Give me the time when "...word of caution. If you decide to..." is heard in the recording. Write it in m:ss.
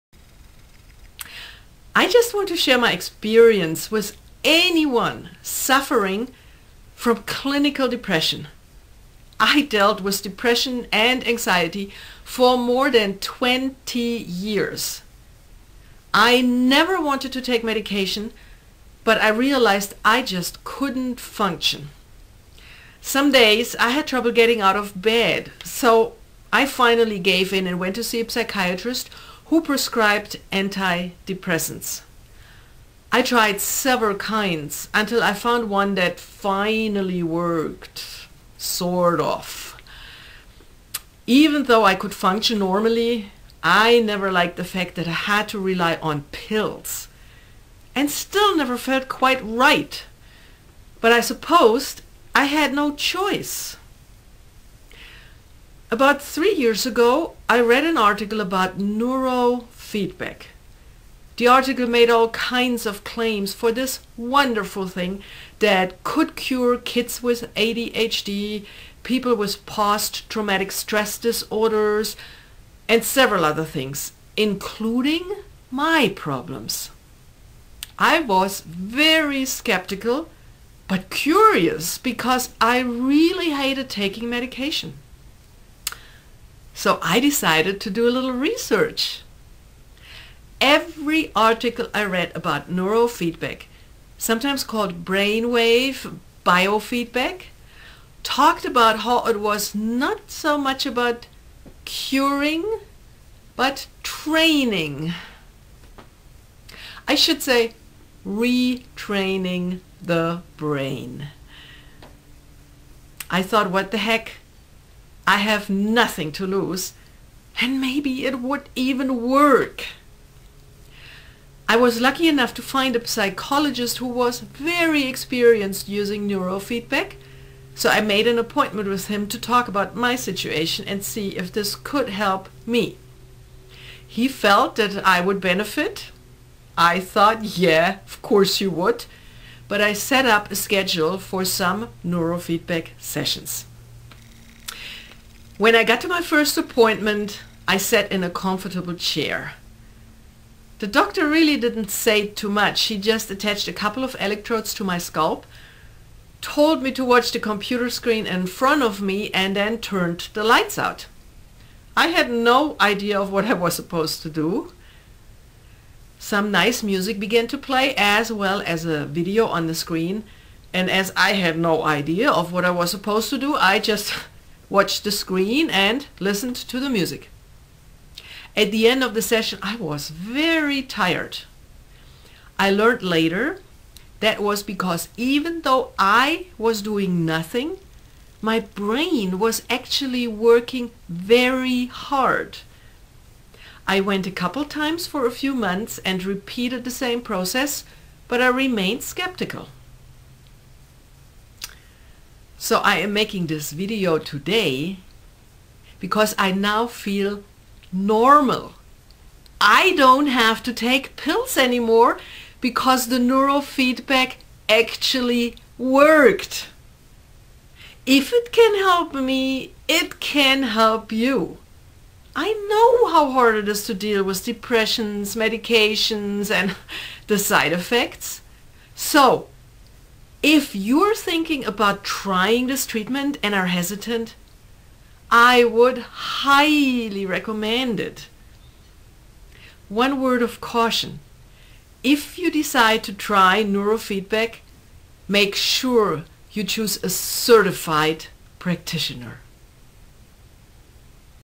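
4:00.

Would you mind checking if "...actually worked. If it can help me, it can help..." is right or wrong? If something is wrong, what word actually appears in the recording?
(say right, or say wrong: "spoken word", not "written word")
right.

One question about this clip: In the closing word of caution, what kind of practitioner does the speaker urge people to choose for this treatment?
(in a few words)
certified practitioner.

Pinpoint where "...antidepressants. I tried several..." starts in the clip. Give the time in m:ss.
0:30.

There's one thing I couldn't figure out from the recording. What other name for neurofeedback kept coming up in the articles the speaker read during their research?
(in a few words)
brainwave biofeedback.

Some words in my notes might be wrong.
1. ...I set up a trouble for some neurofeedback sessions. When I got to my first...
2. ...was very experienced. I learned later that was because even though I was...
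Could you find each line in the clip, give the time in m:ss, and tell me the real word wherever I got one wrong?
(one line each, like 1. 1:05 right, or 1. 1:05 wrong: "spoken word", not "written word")
1. 2:19 wrong: "schedule", not "trouble"
2. 2:59 wrong: "tired", not "experienced".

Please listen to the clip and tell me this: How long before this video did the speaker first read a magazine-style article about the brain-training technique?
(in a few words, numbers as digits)
three years ago.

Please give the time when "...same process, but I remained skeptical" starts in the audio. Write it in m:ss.
3:17.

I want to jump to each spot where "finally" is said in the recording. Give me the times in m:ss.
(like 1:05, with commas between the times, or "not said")
0:26, 0:36.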